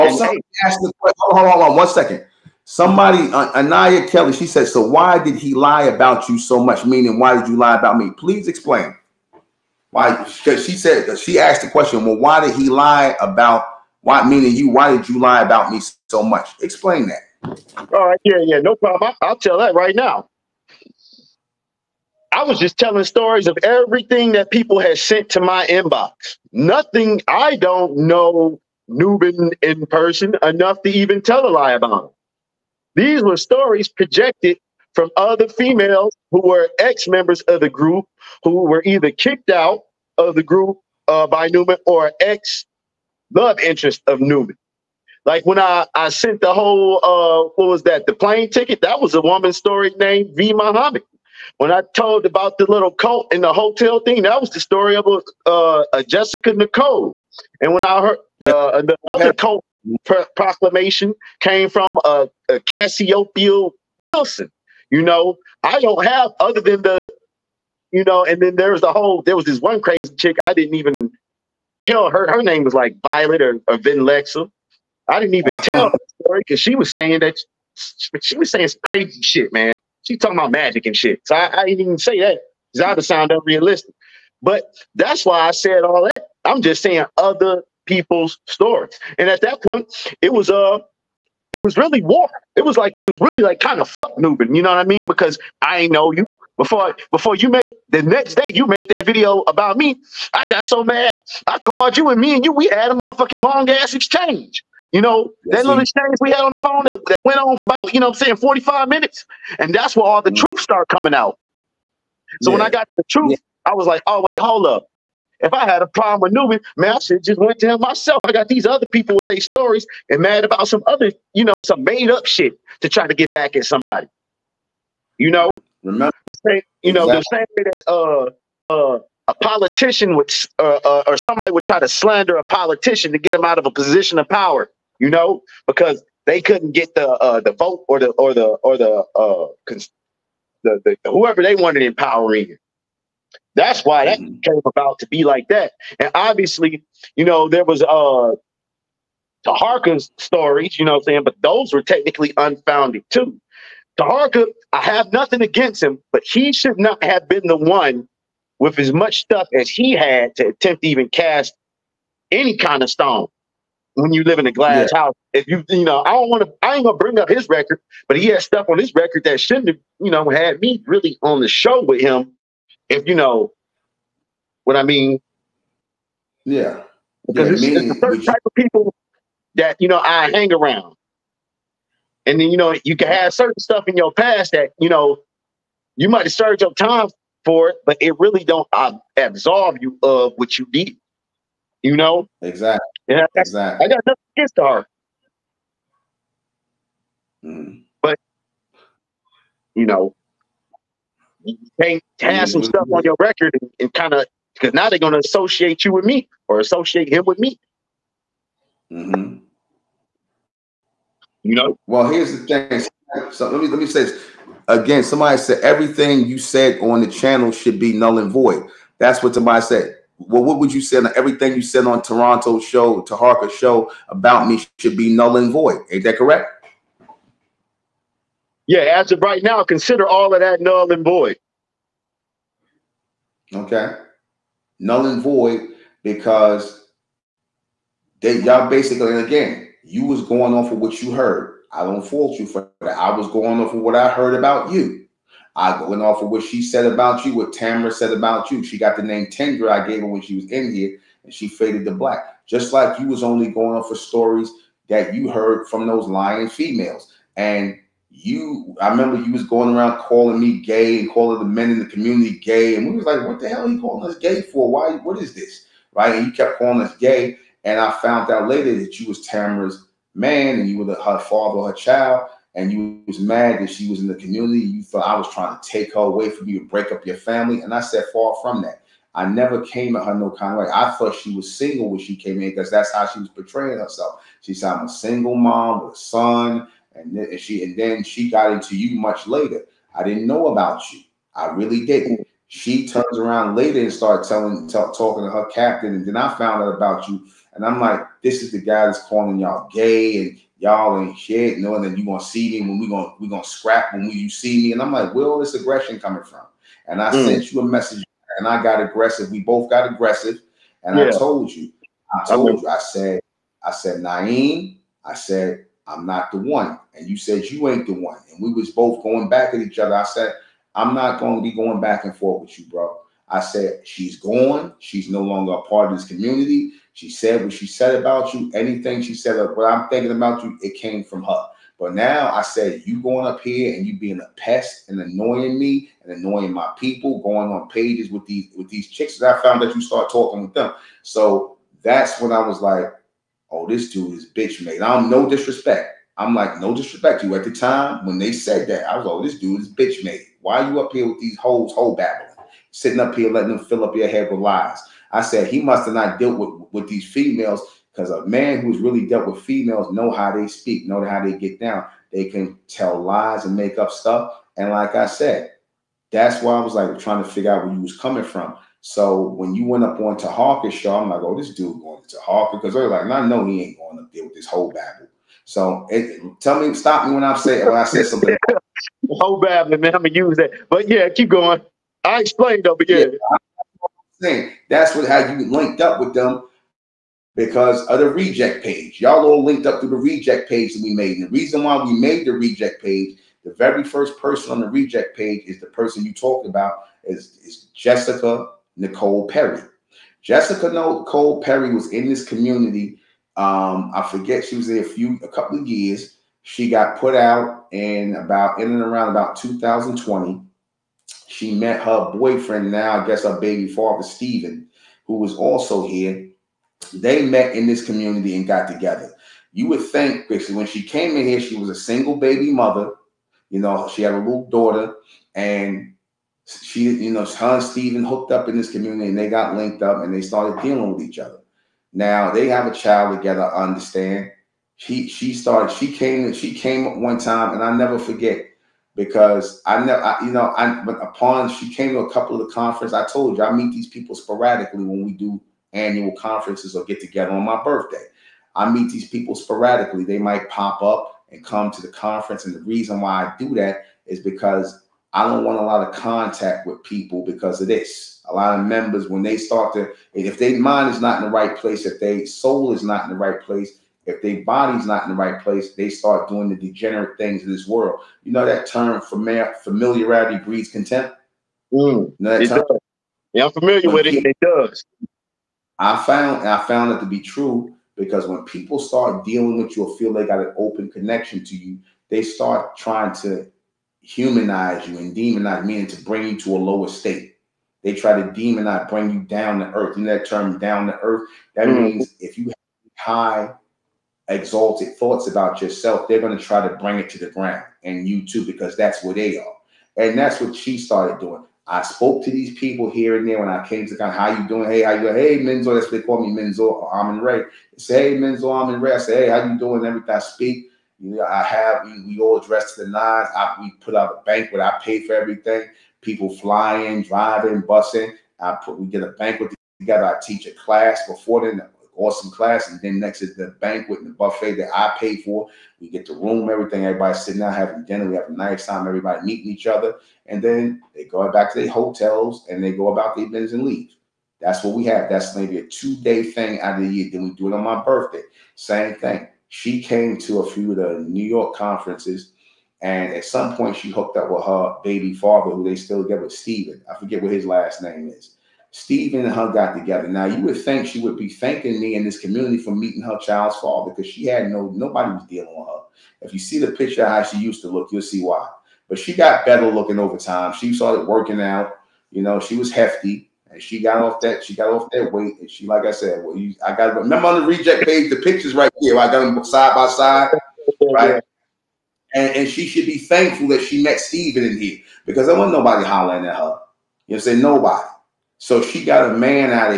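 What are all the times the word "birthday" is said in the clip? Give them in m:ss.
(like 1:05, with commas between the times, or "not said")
7:27, 8:57.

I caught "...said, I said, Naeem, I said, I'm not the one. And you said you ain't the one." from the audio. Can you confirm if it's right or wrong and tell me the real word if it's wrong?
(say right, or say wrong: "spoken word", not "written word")
right.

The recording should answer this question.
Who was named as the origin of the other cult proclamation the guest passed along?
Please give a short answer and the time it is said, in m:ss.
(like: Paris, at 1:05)
Cassiopeia Wilson, at 1:02.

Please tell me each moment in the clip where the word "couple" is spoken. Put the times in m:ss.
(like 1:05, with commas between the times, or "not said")
6:45, 7:22.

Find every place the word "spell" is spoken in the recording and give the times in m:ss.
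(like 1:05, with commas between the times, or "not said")
not said.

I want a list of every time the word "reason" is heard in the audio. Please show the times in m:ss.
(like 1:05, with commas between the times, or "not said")
6:31, 7:32.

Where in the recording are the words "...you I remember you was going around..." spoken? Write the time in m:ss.
4:18.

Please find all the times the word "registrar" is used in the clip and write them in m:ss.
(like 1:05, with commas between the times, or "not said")
not said.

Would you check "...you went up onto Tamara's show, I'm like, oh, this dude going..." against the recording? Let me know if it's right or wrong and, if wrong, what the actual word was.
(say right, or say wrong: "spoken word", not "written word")
wrong: "Hawker", not "Tamara".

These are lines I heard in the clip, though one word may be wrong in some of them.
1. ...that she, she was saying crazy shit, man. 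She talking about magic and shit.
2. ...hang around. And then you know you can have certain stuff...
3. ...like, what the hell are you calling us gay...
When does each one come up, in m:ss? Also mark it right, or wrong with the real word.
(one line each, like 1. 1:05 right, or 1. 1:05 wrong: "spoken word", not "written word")
1. 1:17 right
2. 3:00 right
3. 4:23 right.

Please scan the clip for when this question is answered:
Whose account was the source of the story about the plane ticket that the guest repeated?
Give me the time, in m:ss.
0:50.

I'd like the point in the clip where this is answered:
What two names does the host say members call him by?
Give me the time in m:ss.
8:26.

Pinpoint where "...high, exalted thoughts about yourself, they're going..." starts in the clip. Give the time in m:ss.
8:12.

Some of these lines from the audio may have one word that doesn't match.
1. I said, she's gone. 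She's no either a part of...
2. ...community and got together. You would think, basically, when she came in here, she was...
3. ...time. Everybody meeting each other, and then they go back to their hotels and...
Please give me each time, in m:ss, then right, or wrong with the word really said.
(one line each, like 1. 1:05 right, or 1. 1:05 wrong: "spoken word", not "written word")
1. 5:23 wrong: "longer", not "either"
2. 6:57 right
3. 8:48 right.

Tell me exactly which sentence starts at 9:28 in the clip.
I got them side by side, right?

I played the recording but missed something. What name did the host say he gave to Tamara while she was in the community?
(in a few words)
Tendra.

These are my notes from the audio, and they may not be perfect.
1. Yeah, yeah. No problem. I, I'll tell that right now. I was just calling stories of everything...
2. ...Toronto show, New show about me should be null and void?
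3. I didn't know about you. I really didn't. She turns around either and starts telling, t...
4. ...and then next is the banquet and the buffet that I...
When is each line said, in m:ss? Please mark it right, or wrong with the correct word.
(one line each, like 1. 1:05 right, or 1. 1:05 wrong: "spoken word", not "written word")
1. 0:18 wrong: "telling", not "calling"
2. 3:42 wrong: "Taharka", not "New"
3. 4:49 wrong: "later", not "either"
4. 8:42 right.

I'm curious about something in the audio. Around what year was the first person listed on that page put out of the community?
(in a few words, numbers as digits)
2020.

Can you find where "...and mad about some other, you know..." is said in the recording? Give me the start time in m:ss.
2:00.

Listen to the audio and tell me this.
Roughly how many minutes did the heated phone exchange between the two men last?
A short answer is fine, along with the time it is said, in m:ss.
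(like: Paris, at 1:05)
45, at 1:48.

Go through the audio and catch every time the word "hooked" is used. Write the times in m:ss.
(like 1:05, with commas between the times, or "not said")
7:08, 9:03.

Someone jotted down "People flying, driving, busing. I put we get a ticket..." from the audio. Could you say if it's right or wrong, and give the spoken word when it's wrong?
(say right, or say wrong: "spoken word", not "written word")
wrong: "banquet", not "ticket".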